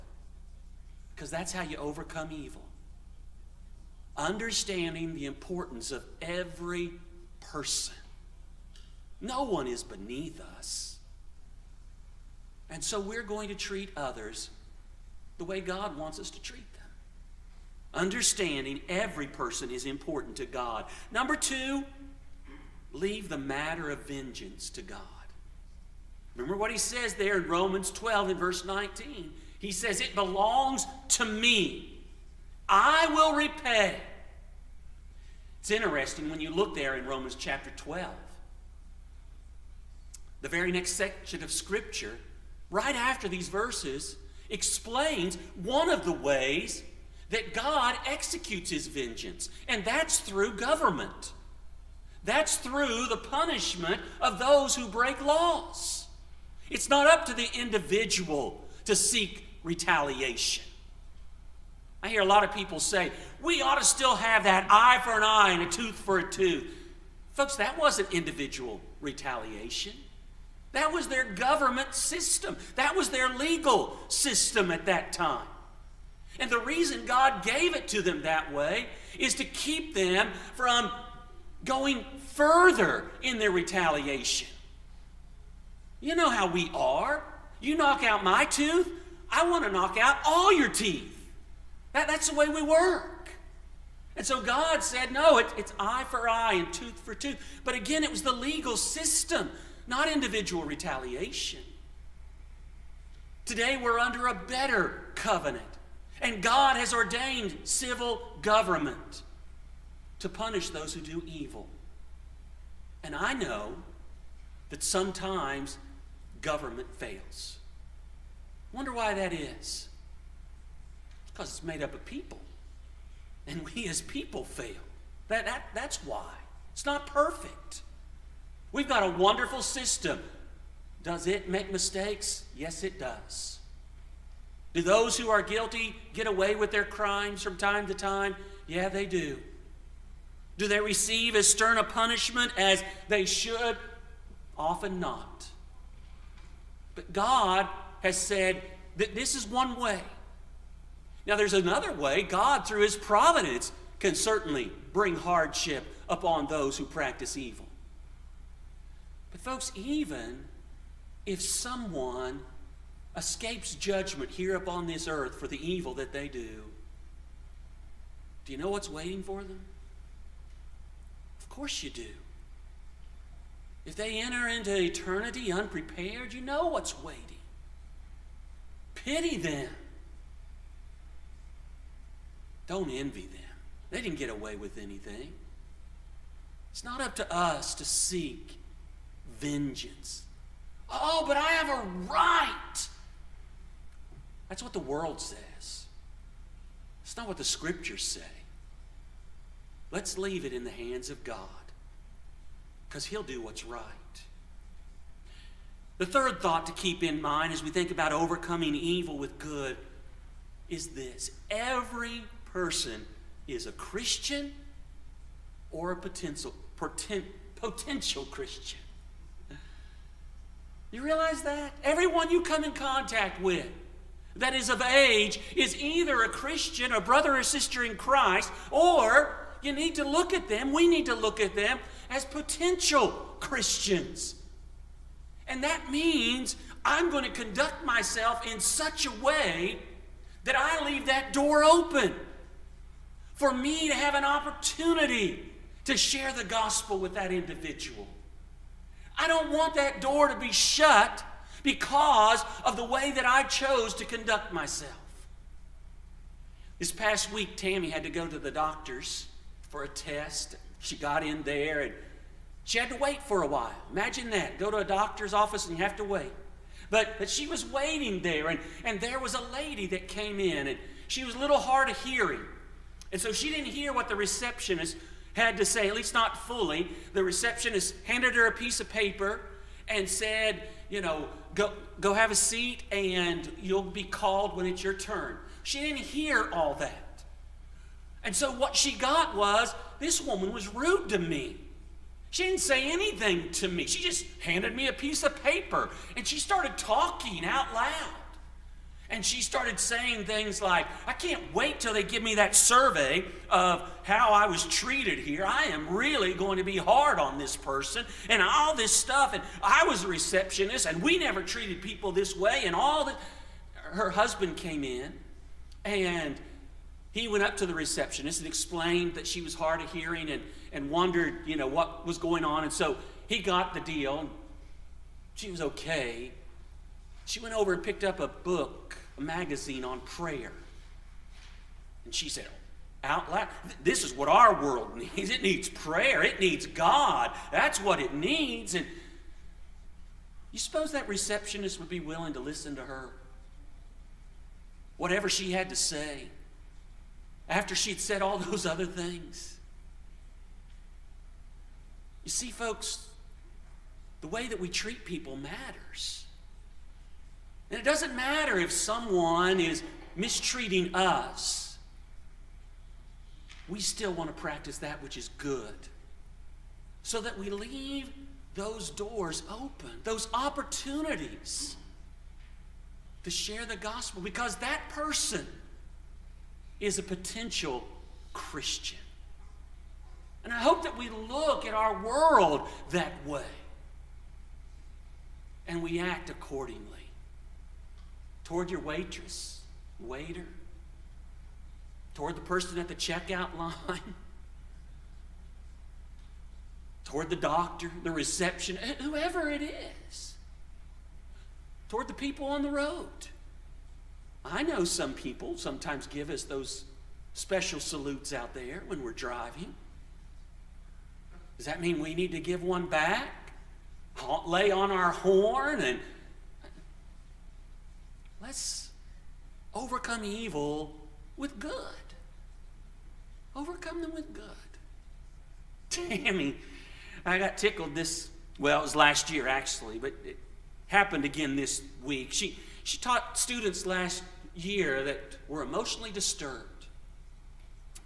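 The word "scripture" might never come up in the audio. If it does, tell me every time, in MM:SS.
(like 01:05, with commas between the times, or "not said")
00:41, 03:17.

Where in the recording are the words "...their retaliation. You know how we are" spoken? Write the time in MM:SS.
01:23.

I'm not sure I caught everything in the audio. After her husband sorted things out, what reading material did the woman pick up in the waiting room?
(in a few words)
A magazine on prayer.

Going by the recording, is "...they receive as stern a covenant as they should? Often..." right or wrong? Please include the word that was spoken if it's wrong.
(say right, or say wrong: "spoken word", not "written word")
wrong: "punishment", not "covenant".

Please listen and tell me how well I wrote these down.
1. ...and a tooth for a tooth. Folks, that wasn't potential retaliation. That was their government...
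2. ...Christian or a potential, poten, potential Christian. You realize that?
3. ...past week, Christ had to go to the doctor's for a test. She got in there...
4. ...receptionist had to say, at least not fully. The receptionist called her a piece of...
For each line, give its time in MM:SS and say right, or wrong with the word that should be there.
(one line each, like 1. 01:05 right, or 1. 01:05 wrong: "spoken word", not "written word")
1. 01:05 wrong: "individual", not "potential"
2. 03:33 right
3. 04:16 wrong: "Tammy", not "Christ"
4. 04:34 wrong: "handed", not "called".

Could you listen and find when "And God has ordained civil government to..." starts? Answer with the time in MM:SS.
01:46.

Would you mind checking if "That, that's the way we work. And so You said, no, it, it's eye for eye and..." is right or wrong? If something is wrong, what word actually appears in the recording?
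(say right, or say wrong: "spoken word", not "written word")
wrong: "God", not "You".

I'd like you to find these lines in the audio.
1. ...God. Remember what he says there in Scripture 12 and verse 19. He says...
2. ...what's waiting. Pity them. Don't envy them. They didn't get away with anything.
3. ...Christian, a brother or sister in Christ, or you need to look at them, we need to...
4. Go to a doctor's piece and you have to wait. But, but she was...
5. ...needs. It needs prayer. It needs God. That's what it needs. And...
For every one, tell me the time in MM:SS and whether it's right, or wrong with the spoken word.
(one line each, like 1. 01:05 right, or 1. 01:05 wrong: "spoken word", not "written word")
1. 00:24 wrong: "Romans", not "Scripture"
2. 02:56 right
3. 03:46 right
4. 04:24 wrong: "office", not "piece"
5. 05:34 right.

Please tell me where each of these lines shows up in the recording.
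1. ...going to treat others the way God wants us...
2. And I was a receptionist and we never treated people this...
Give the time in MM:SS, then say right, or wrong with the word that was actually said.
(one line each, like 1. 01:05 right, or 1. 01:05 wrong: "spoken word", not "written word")
1. 00:13 right
2. 05:09 right.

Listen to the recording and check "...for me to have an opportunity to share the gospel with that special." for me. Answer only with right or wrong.
wrong.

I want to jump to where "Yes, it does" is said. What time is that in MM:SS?
02:12.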